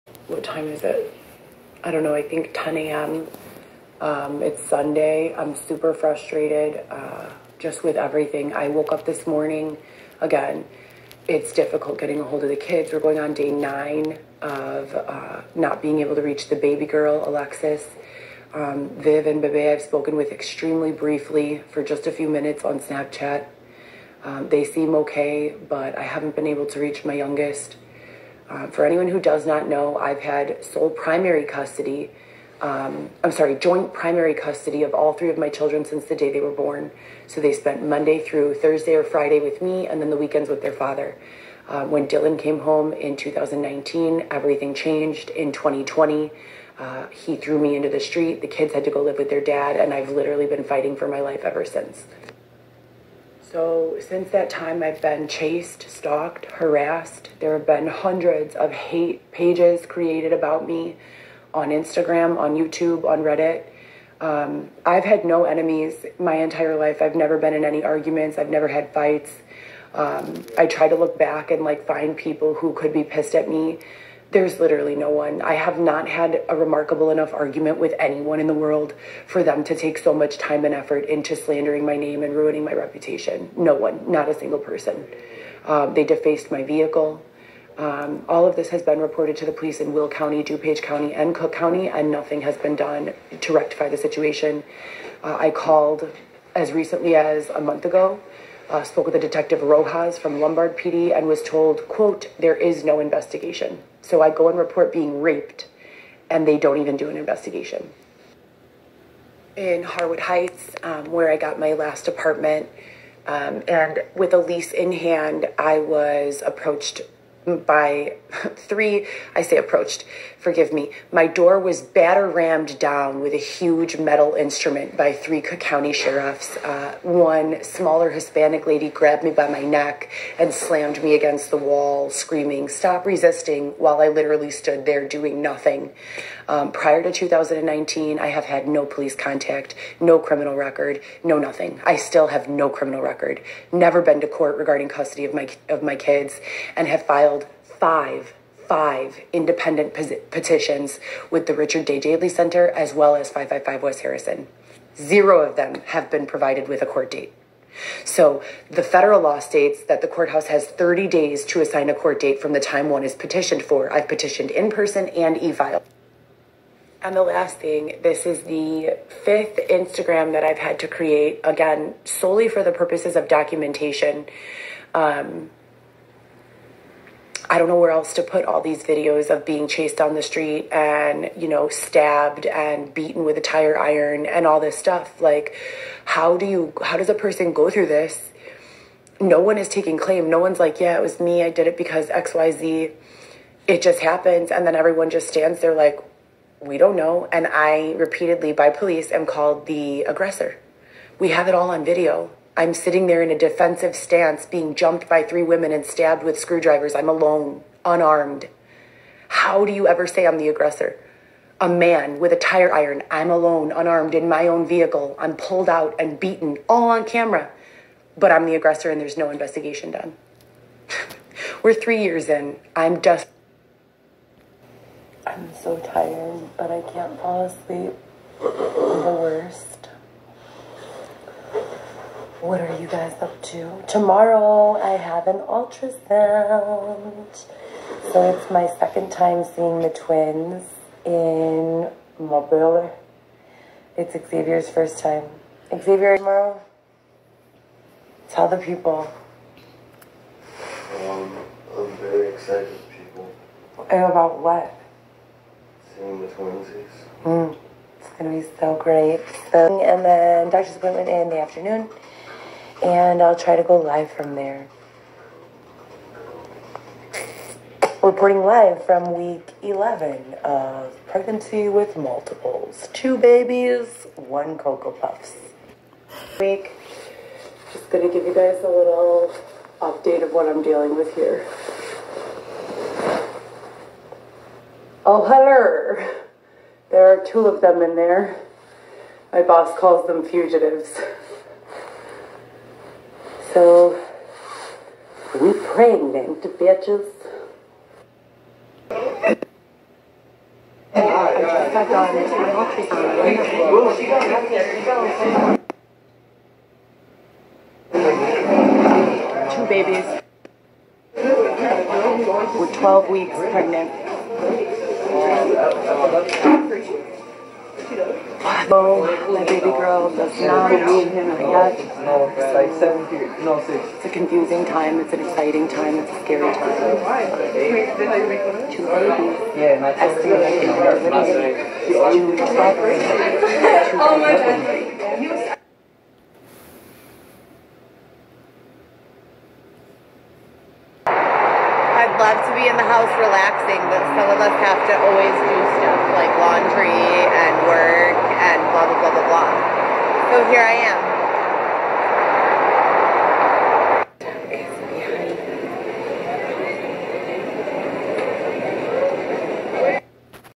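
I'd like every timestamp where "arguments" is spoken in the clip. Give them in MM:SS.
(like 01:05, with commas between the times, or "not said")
01:07, 01:17.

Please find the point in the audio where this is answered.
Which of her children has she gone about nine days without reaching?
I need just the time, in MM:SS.
00:17.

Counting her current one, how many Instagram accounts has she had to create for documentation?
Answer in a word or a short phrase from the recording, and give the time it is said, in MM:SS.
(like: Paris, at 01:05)
fifth, at 02:49.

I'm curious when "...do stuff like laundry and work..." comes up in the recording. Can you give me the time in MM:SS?
05:45.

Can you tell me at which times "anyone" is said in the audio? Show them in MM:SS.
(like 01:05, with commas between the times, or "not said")
00:28, 01:17.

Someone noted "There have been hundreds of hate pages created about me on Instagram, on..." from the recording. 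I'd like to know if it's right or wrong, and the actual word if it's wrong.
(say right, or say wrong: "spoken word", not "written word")
right.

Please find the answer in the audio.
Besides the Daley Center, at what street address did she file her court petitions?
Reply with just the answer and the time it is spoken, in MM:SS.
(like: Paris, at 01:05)
555 West Harrison, at 02:33.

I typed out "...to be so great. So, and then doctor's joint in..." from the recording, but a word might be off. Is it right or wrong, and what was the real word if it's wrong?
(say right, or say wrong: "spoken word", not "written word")
wrong: "appointment", not "joint".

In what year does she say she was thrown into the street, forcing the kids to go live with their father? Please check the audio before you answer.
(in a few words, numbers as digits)
2020.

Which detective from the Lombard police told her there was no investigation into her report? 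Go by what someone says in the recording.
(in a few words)
Rojas.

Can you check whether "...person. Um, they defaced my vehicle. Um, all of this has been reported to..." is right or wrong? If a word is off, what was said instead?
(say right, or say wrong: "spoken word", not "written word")
right.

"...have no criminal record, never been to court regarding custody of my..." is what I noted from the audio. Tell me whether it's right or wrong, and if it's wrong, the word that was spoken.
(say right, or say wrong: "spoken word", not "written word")
right.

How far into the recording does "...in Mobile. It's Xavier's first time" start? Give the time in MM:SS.
04:01.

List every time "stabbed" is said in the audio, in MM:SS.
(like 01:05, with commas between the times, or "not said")
03:01, 03:25.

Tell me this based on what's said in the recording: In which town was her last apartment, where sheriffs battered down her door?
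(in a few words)
Harwood Heights.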